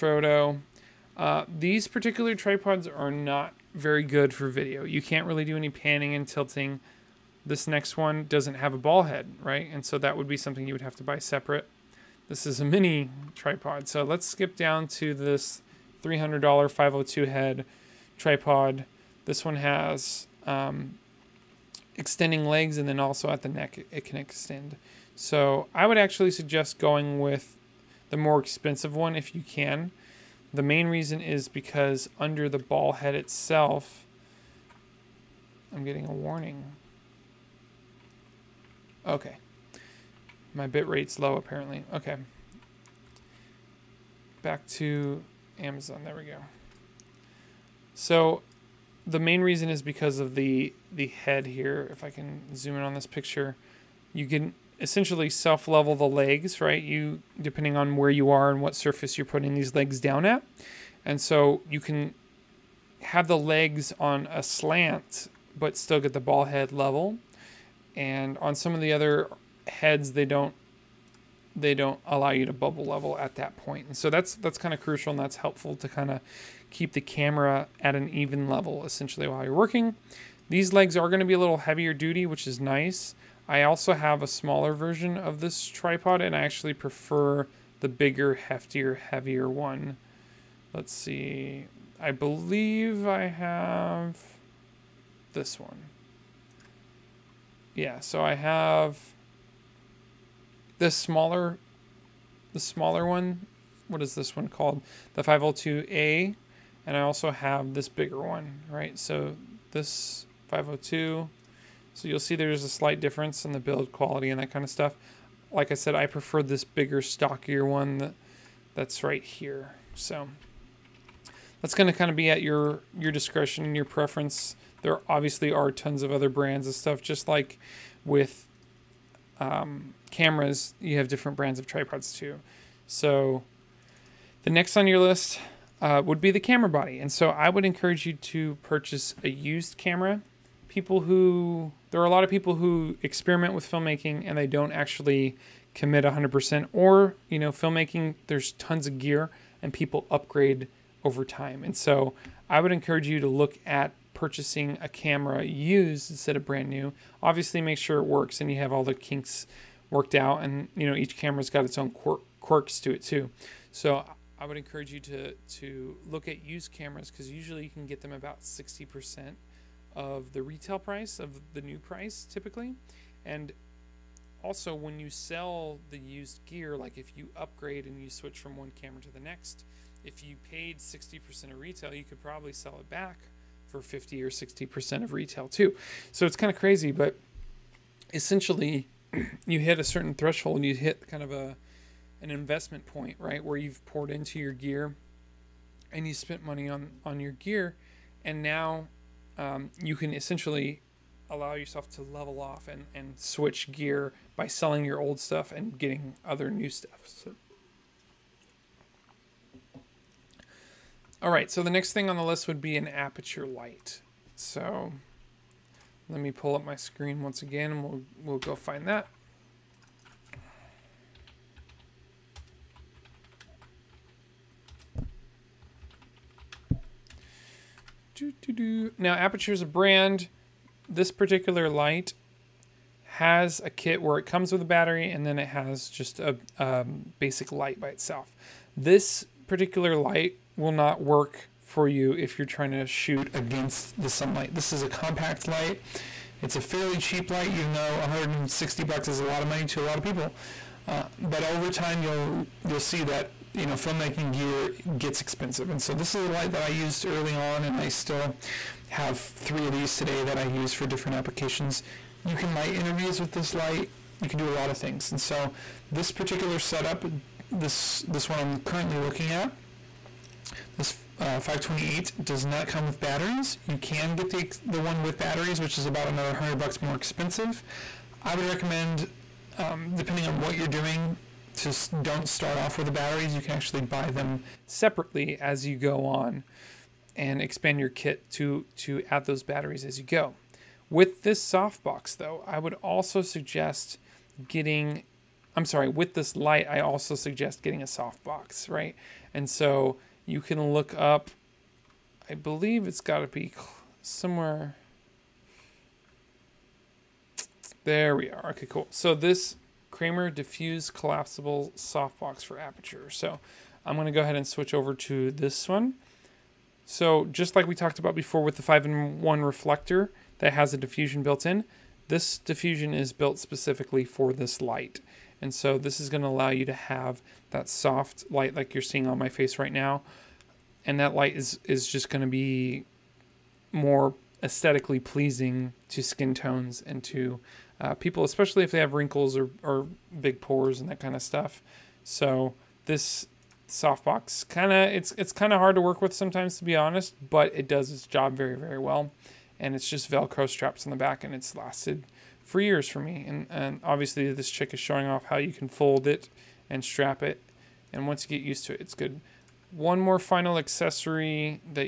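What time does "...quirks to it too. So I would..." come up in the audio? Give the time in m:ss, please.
2:42.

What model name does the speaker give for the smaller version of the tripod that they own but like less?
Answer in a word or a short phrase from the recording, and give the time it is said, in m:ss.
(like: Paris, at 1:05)
502A, at 1:45.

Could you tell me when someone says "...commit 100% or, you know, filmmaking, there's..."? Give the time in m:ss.
2:25.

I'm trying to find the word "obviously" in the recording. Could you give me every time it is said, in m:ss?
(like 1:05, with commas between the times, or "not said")
2:05, 2:37, 5:53.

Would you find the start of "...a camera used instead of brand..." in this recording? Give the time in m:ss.
2:34.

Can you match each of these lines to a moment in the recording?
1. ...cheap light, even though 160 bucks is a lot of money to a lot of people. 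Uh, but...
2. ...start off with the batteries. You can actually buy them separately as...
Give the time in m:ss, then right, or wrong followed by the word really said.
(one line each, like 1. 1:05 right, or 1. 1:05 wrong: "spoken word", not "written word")
1. 4:06 right
2. 4:42 right.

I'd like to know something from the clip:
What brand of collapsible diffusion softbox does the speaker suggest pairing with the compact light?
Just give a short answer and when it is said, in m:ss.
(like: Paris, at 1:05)
Kramer, at 5:09.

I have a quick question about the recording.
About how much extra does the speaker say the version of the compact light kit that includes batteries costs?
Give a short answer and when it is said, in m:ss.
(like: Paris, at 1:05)
$100, at 4:35.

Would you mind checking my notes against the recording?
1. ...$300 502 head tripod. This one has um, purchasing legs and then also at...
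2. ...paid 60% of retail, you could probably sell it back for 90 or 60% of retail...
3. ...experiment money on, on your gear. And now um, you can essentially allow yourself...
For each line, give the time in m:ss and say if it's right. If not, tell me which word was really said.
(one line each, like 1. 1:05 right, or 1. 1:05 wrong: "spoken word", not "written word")
1. 0:16 wrong: "extending", not "purchasing"
2. 3:00 wrong: "50", not "90"
3. 3:16 wrong: "spent", not "experiment".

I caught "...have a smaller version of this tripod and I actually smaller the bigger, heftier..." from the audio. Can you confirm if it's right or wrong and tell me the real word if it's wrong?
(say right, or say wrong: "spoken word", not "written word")
wrong: "prefer", not "smaller".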